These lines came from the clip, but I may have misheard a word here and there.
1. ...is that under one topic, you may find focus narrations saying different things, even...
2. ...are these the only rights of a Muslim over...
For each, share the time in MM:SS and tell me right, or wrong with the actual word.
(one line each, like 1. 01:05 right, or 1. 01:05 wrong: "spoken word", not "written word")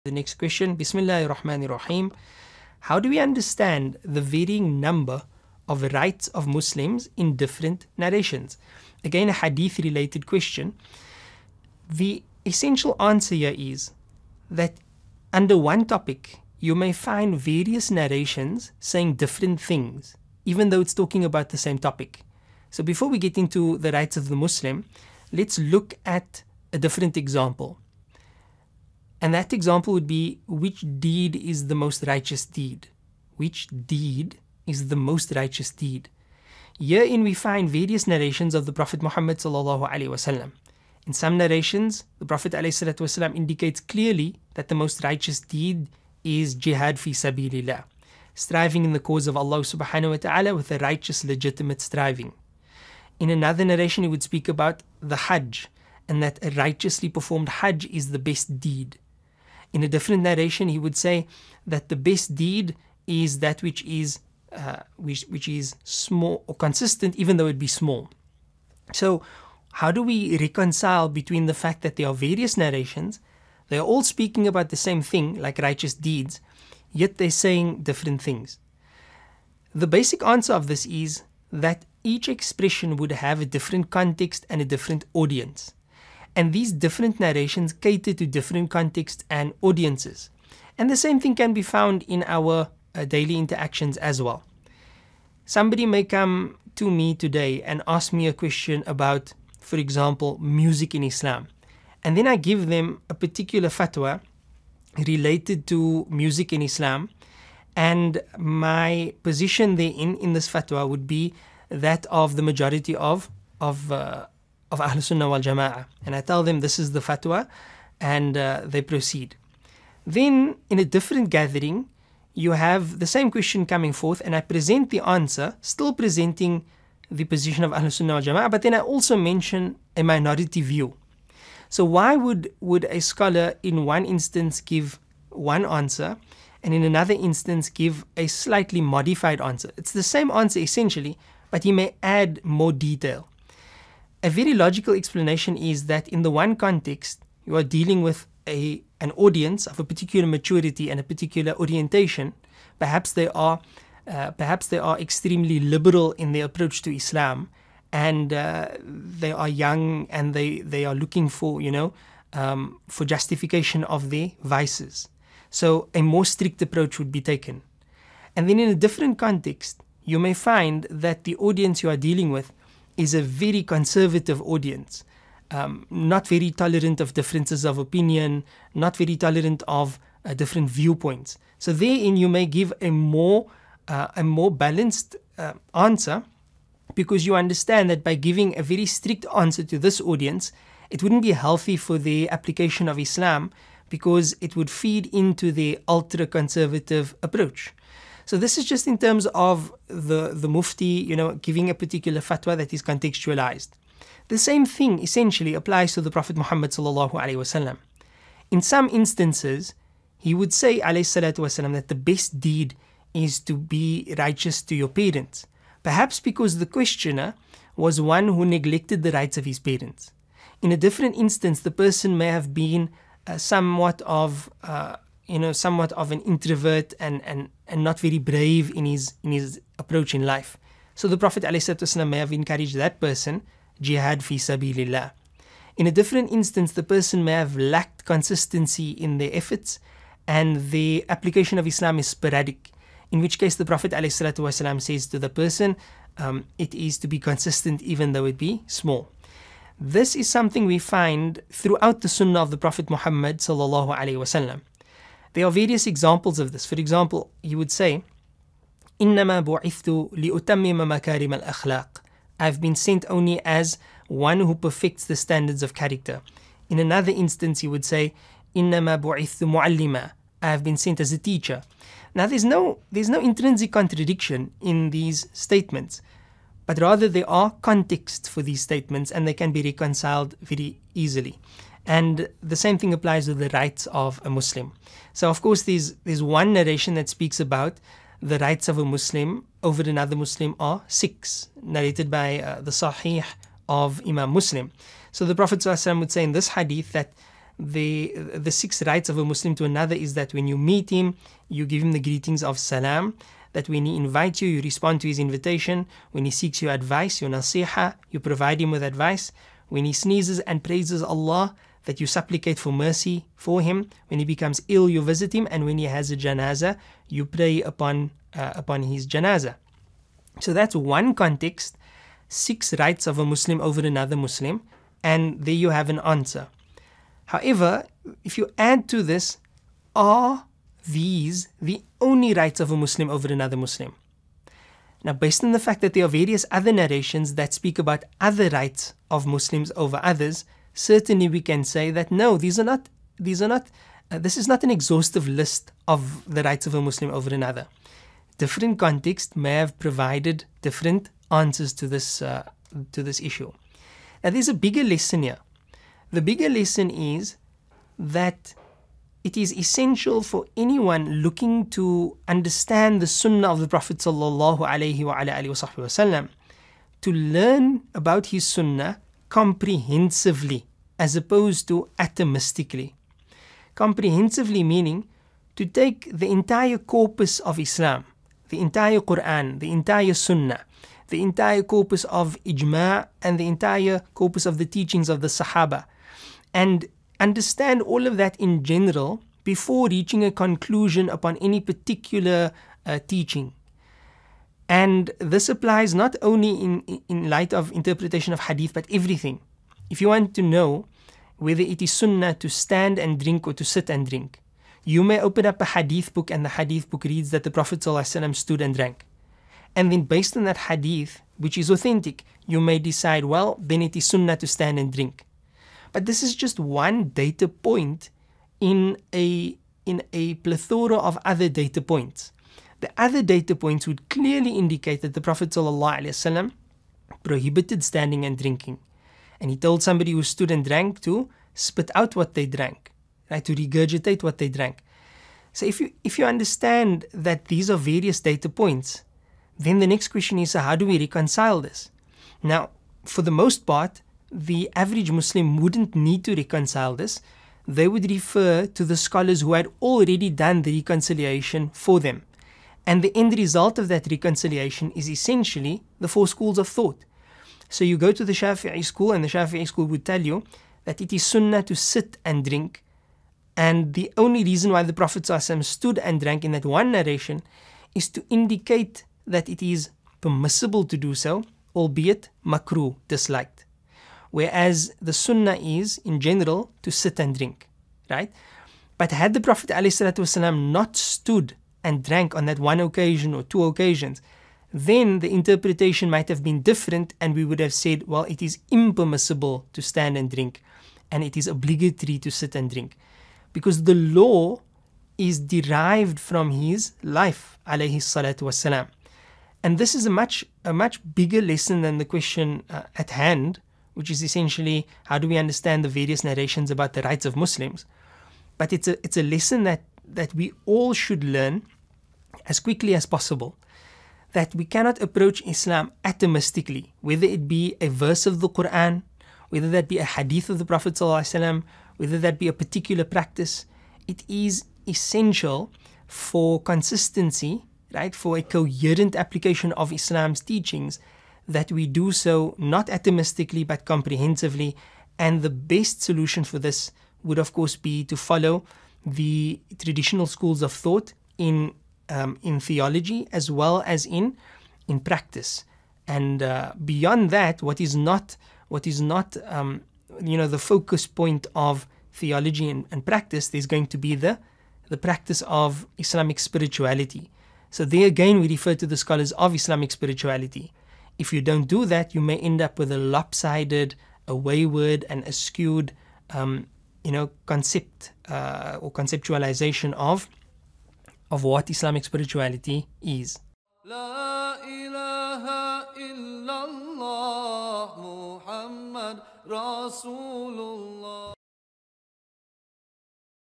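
1. 00:13 wrong: "various", not "focus"
2. 05:29 right.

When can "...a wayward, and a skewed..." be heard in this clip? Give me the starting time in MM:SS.
09:24.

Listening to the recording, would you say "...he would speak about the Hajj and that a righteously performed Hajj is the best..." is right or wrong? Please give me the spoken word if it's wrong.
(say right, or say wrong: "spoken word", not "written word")
right.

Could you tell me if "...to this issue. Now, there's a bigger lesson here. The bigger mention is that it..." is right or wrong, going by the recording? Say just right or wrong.
wrong.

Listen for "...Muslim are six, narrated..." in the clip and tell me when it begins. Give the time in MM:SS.
04:50.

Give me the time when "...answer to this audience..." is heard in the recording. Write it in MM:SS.
03:09.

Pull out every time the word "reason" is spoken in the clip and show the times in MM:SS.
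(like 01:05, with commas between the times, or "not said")
07:44.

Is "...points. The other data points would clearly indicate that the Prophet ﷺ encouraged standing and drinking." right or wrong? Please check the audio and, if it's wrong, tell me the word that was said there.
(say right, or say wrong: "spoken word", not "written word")
wrong: "prohibited", not "encouraged".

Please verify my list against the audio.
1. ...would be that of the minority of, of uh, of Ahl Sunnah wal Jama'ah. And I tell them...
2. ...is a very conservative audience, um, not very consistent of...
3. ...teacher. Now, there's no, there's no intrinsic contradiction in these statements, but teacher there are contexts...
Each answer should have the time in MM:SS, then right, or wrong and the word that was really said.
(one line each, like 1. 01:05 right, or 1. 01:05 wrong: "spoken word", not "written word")
1. 01:50 wrong: "majority", not "minority"
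2. 02:53 wrong: "tolerant", not "consistent"
3. 04:31 wrong: "rather", not "teacher".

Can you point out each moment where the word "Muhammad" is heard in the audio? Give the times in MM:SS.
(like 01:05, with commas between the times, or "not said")
00:39, 03:26, 04:12.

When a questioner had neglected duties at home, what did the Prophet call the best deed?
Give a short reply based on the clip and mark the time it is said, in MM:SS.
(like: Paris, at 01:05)
to be righteous to your parents, at 03:33.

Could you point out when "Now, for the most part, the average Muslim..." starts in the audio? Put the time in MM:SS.
07:22.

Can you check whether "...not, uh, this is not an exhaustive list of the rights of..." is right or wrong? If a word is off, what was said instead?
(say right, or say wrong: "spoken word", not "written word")
right.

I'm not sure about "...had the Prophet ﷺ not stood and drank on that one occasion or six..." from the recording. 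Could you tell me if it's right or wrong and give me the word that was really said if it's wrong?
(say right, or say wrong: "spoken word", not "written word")
wrong: "two", not "six".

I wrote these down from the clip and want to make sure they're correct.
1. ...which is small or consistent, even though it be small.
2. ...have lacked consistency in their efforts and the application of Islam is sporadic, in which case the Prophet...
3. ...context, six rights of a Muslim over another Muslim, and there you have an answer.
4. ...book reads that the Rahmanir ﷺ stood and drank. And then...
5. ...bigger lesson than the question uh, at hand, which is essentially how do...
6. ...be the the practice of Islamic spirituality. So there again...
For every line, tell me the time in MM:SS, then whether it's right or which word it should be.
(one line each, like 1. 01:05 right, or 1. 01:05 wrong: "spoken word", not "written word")
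1. 01:05 right
2. 03:57 right
3. 05:21 right
4. 06:46 wrong: "Prophet", not "Rahmanir"
5. 08:21 right
6. 09:13 right.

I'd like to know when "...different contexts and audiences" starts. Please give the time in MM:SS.
01:28.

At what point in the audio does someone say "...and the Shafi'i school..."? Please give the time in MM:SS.
07:39.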